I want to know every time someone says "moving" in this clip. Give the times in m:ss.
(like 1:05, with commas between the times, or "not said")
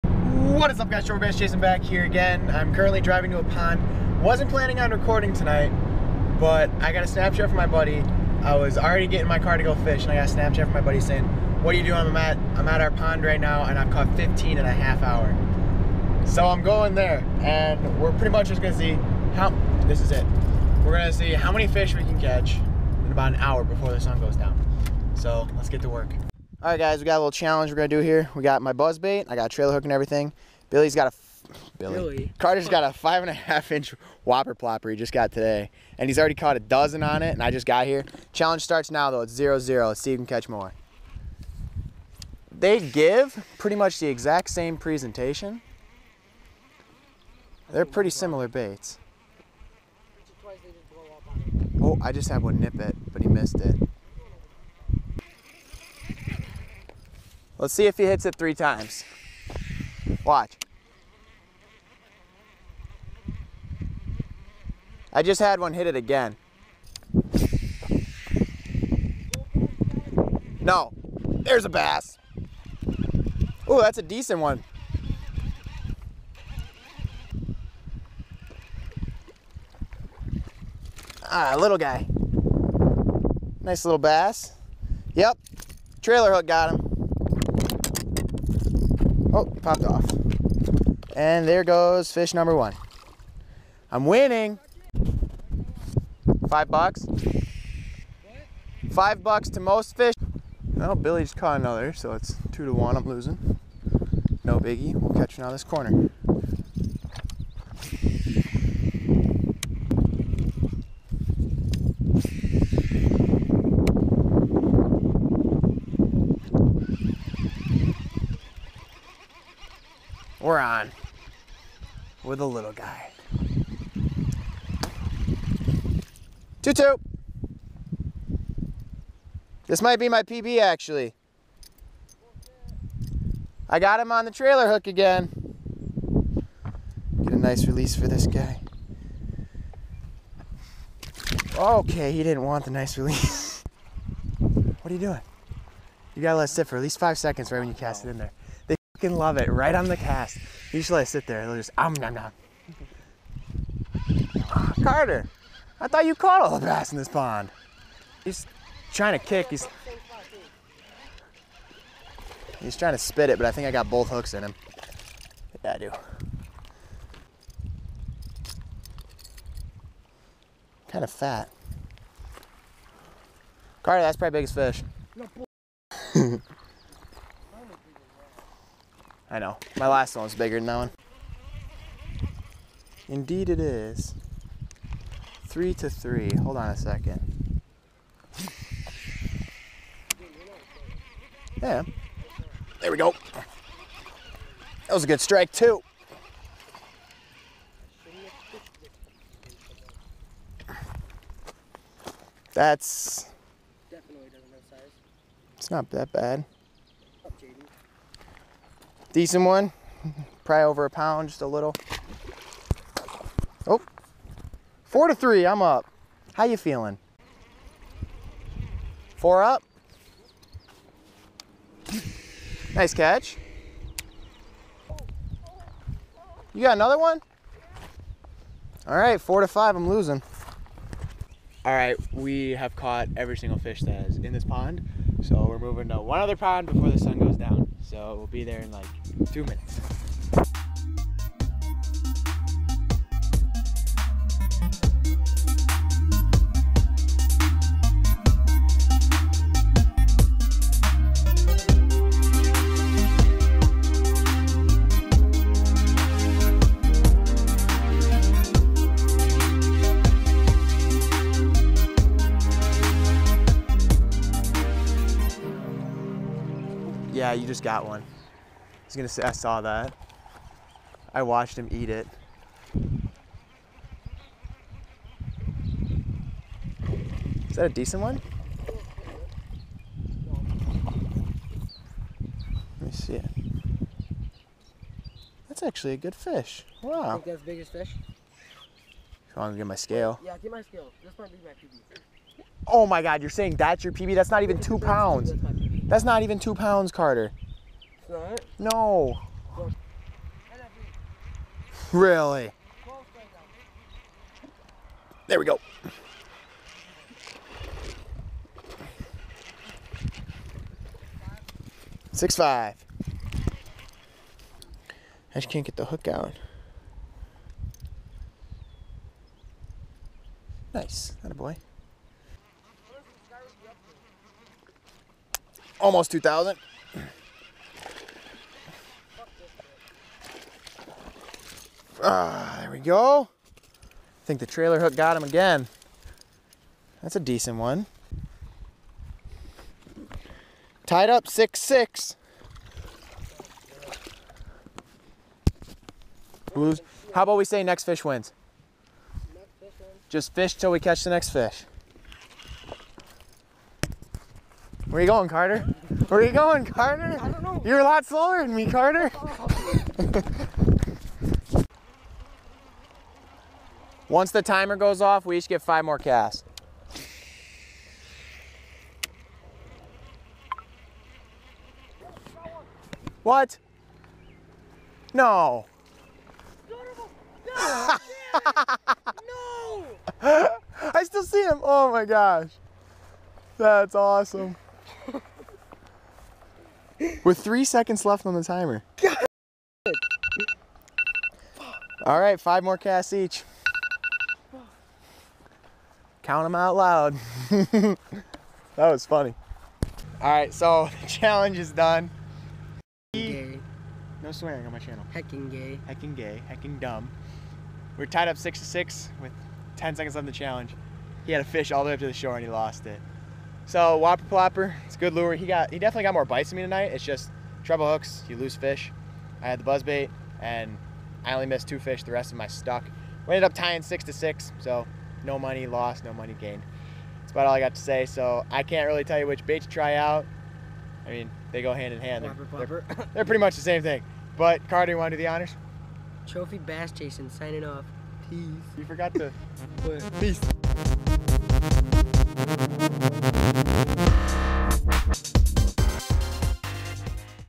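3:55.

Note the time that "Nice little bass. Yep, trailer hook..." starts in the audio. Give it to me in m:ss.
1:23.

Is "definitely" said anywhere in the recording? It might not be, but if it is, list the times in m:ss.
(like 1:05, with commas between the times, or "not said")
6:55.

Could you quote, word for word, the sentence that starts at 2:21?
Okay, he didn't want the nice release.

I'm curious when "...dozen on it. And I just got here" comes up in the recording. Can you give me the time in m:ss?
0:36.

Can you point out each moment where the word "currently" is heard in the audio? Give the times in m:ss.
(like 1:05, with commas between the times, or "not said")
0:02.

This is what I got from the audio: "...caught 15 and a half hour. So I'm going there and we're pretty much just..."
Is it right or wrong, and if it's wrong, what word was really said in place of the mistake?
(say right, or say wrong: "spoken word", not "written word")
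right.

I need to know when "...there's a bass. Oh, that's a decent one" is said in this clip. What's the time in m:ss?
1:11.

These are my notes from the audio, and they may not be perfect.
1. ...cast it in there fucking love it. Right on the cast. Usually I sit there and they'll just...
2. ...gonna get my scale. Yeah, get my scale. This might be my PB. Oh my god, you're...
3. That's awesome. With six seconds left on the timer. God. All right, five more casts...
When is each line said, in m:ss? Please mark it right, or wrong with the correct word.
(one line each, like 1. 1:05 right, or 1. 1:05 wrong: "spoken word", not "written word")
1. 2:27 right
2. 4:49 right
3. 6:23 wrong: "three", not "six".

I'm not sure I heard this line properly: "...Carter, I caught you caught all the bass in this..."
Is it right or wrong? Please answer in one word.
wrong.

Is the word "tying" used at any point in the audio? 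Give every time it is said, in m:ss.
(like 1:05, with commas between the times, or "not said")
7:03.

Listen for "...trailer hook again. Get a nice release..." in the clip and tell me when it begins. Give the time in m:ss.
2:14.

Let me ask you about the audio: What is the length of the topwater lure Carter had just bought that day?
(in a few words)
5.5 inches.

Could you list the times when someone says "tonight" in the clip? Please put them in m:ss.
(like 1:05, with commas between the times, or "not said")
0:05, 6:56.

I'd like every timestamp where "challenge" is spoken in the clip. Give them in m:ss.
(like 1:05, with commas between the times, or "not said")
0:27, 0:38, 6:41, 6:50.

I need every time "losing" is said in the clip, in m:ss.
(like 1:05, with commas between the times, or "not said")
1:43, 3:49.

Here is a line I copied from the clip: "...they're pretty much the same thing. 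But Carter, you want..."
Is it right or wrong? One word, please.
right.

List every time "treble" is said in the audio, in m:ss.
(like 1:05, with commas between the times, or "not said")
6:57.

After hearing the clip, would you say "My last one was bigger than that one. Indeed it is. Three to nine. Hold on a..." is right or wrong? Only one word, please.
wrong.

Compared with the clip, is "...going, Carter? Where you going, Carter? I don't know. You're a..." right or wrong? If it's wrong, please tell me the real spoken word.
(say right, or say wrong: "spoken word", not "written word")
right.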